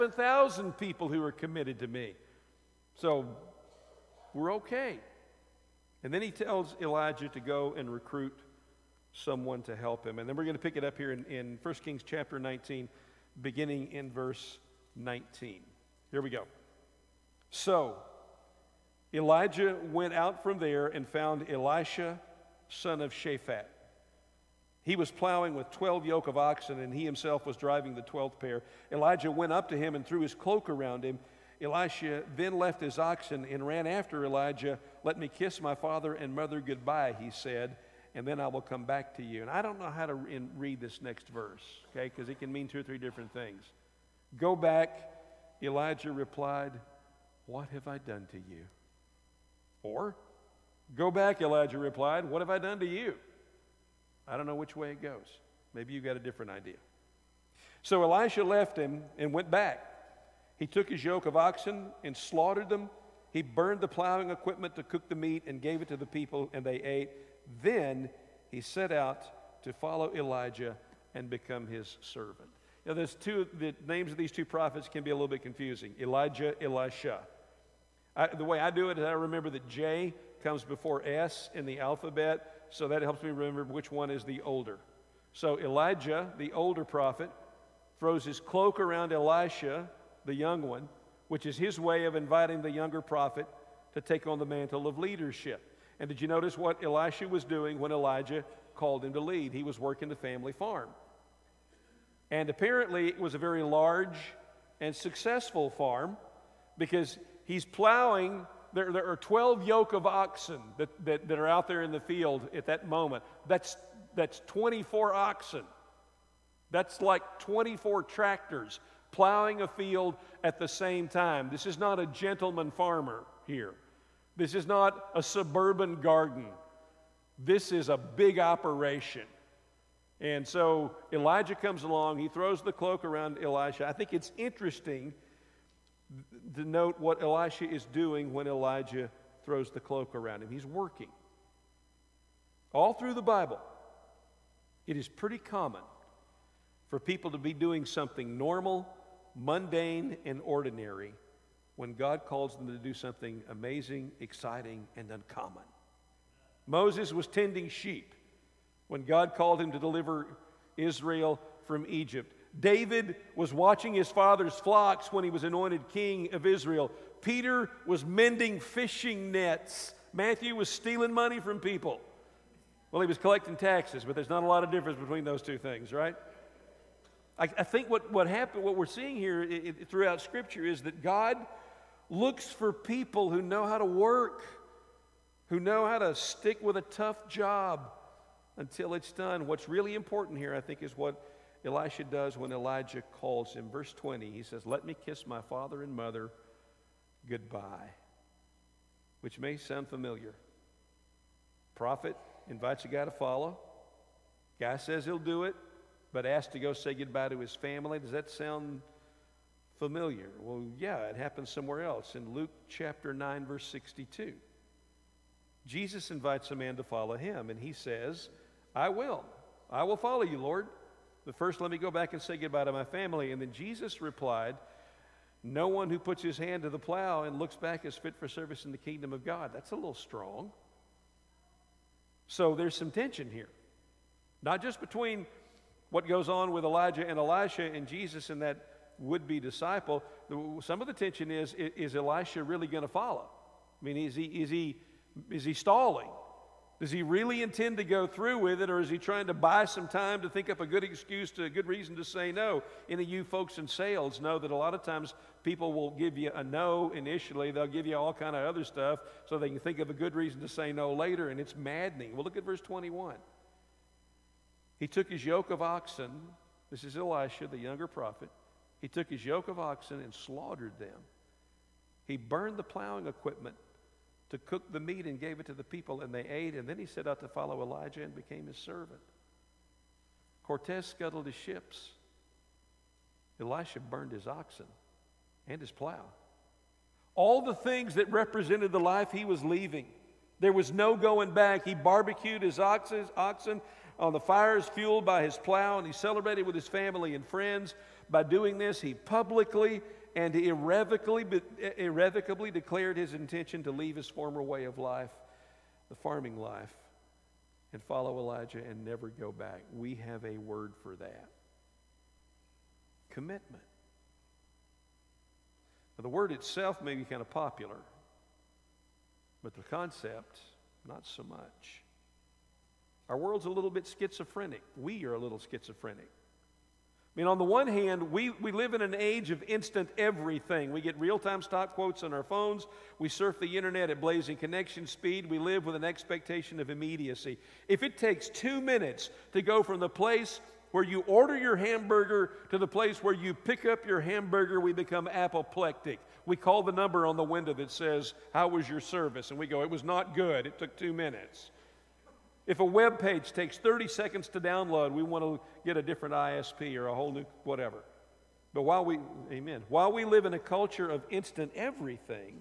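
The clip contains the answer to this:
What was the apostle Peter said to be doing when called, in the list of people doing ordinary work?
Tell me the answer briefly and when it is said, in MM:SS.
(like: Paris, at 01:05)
Mending fishing nets, at 02:48.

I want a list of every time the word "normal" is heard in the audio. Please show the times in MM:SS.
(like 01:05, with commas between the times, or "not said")
02:28.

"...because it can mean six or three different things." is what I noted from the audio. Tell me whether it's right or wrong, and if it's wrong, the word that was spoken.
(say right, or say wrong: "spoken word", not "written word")
wrong: "two", not "six".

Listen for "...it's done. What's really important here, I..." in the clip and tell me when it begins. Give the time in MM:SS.
03:08.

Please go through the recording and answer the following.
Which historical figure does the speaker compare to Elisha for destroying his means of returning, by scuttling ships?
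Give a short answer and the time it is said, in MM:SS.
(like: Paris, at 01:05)
Cortez, at 04:40.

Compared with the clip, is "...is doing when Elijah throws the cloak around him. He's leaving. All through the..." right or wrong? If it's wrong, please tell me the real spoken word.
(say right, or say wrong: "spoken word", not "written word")
wrong: "working", not "leaving".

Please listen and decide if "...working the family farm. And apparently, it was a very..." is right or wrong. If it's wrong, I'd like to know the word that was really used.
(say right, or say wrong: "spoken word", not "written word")
right.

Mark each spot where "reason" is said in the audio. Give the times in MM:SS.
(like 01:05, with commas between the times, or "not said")
04:11, 04:20.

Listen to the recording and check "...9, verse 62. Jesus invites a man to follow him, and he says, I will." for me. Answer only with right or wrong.
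right.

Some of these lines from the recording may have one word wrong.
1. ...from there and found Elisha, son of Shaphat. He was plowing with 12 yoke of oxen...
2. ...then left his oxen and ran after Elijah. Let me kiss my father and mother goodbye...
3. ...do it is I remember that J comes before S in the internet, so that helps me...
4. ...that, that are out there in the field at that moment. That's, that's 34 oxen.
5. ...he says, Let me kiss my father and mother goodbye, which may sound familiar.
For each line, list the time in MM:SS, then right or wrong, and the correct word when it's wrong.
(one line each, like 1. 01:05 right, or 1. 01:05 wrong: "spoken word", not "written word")
1. 00:20 right
2. 00:32 right
3. 01:18 wrong: "alphabet", not "internet"
4. 01:51 wrong: "24", not "34"
5. 03:14 right.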